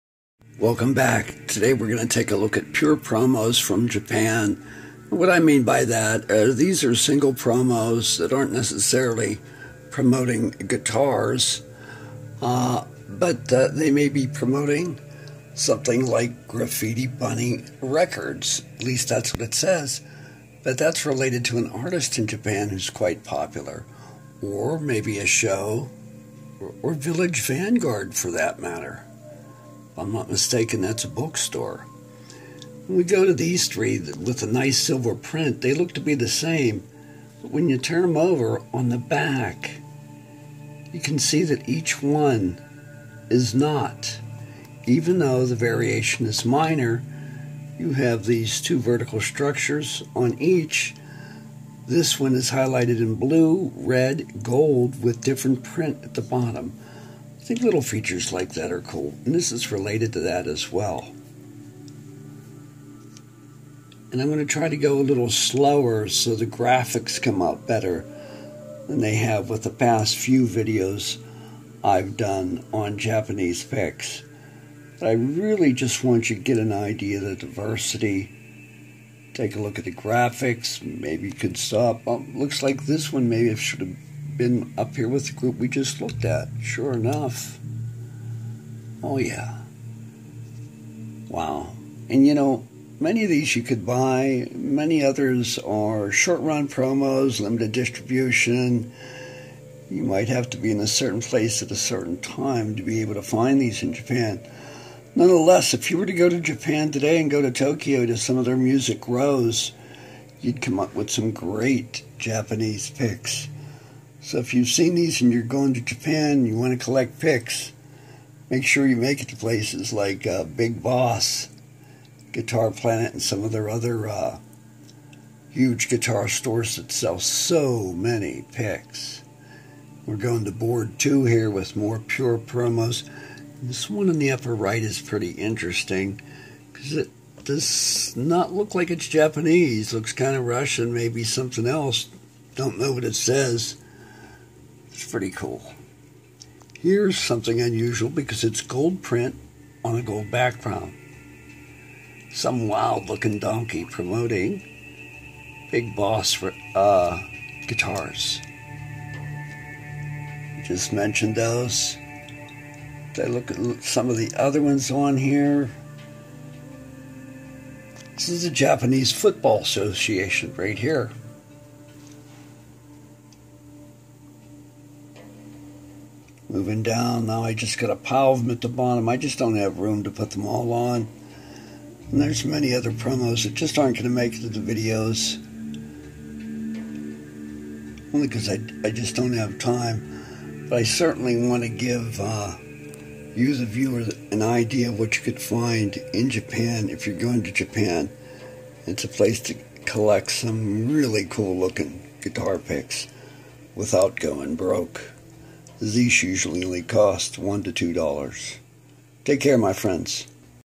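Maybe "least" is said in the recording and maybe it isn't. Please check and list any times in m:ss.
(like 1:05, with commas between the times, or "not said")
0:18.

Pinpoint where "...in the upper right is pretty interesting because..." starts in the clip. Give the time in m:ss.
2:14.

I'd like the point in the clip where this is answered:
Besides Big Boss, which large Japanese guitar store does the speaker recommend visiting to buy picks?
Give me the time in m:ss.
2:02.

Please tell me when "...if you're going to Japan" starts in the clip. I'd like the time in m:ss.
3:16.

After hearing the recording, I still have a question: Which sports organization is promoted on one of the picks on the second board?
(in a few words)
Japanese Football Association.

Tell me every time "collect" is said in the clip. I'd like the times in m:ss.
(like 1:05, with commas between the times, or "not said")
1:56, 3:19.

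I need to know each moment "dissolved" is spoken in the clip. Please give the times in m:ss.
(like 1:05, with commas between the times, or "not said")
not said.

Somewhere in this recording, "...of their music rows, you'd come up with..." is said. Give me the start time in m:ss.
1:48.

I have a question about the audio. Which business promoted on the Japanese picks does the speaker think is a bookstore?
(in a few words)
Village Vanguard.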